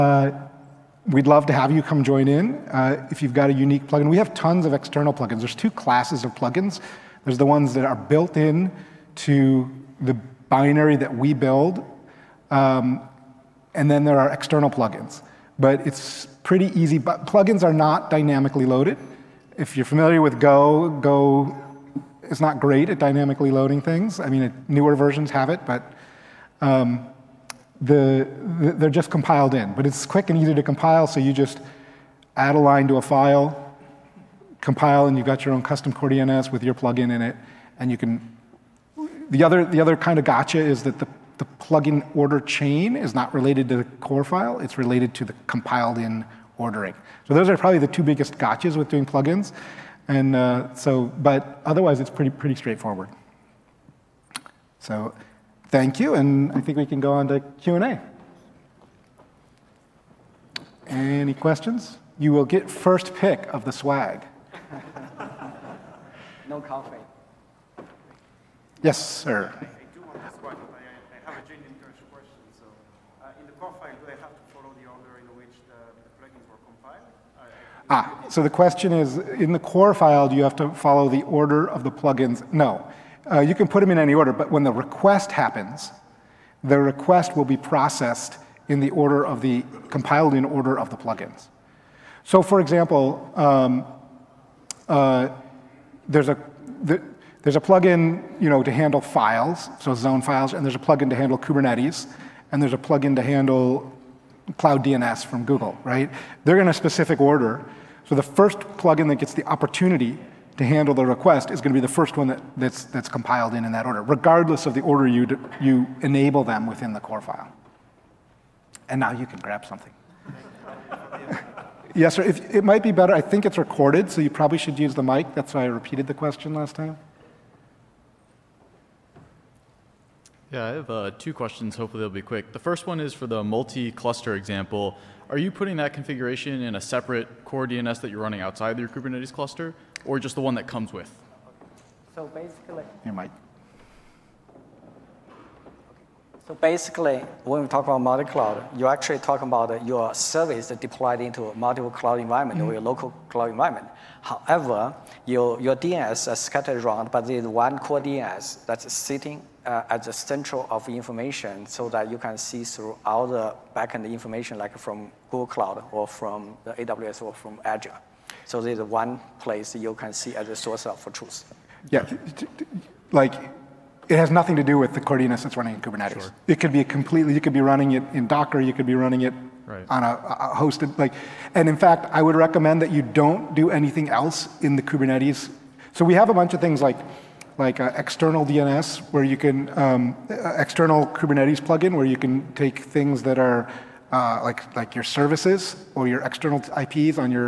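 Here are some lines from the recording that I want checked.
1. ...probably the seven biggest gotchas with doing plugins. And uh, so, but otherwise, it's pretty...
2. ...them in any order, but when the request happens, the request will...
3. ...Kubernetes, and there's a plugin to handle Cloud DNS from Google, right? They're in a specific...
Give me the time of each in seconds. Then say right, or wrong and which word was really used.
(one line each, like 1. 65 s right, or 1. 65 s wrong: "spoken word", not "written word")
1. 47 s wrong: "two", not "seven"
2. 83 s right
3. 101 s right.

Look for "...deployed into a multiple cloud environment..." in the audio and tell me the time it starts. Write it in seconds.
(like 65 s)
150 s.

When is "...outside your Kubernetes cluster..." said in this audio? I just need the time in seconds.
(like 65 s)
138 s.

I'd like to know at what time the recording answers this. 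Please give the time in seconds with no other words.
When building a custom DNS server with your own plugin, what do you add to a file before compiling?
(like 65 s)
32 s.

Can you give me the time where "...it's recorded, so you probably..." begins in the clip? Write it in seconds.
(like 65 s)
123 s.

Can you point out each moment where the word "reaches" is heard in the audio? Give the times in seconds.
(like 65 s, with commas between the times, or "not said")
not said.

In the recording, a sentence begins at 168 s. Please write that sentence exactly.
So there's one place you can see as a source of truth.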